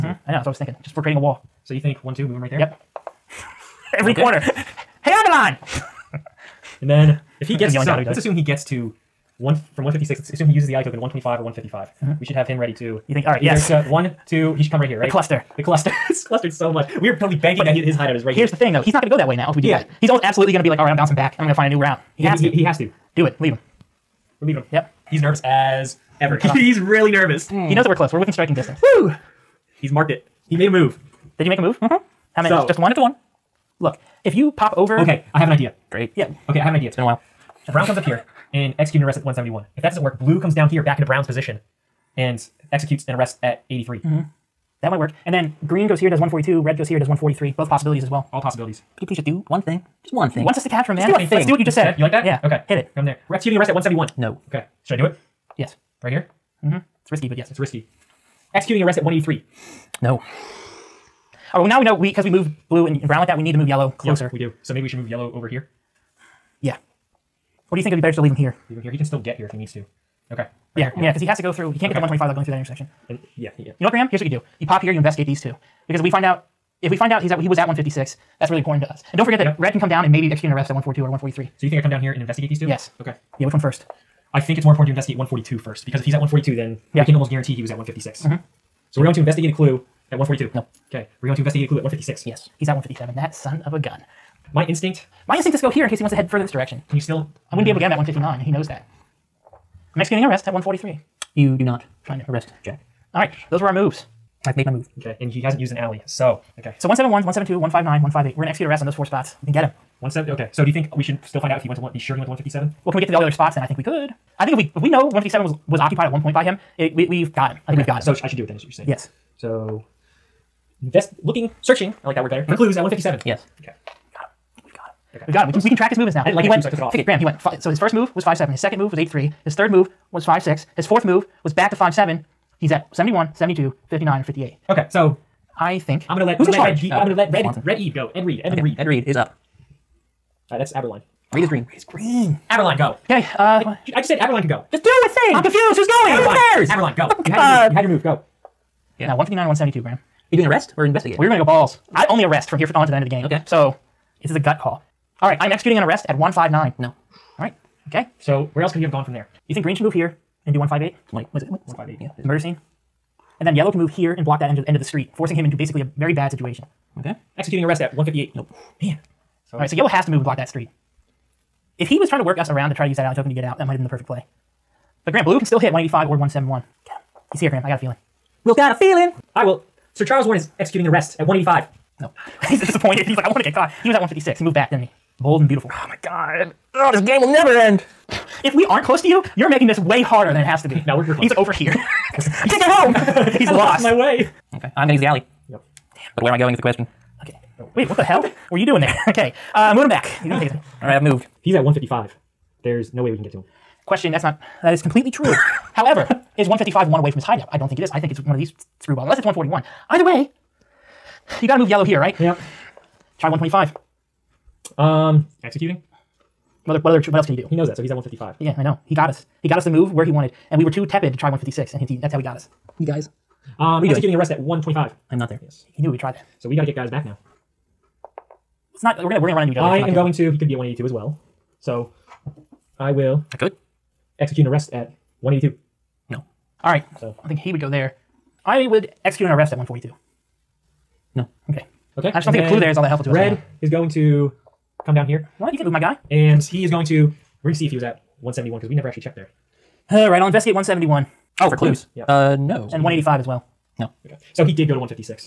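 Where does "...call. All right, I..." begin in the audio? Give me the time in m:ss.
2:34.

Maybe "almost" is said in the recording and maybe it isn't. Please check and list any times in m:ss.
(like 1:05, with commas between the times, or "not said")
0:20, 1:27.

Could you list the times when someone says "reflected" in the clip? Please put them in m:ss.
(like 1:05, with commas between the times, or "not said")
not said.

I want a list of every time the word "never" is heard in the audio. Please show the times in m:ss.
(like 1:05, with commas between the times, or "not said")
3:07, 4:08.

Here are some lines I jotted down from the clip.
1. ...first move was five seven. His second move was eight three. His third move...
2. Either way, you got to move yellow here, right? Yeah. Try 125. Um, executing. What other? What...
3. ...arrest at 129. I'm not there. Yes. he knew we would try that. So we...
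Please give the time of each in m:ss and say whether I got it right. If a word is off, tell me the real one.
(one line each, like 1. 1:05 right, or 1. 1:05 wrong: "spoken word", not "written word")
1. 2:07 right
2. 3:29 right
3. 3:44 wrong: "125", not "129".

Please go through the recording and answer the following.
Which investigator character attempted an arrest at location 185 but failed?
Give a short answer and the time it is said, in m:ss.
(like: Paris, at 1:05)
Sir Charles Warren, at 2:59.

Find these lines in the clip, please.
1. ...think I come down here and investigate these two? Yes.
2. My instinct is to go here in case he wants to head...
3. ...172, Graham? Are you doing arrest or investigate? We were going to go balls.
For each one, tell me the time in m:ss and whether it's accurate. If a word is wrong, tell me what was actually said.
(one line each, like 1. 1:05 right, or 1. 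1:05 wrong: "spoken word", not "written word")
1. 1:21 right
2. 1:35 right
3. 2:29 right.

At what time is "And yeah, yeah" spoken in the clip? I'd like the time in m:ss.
1:13.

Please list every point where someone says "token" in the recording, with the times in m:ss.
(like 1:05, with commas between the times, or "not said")
0:10, 2:53.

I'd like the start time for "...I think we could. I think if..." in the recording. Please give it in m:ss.
1:53.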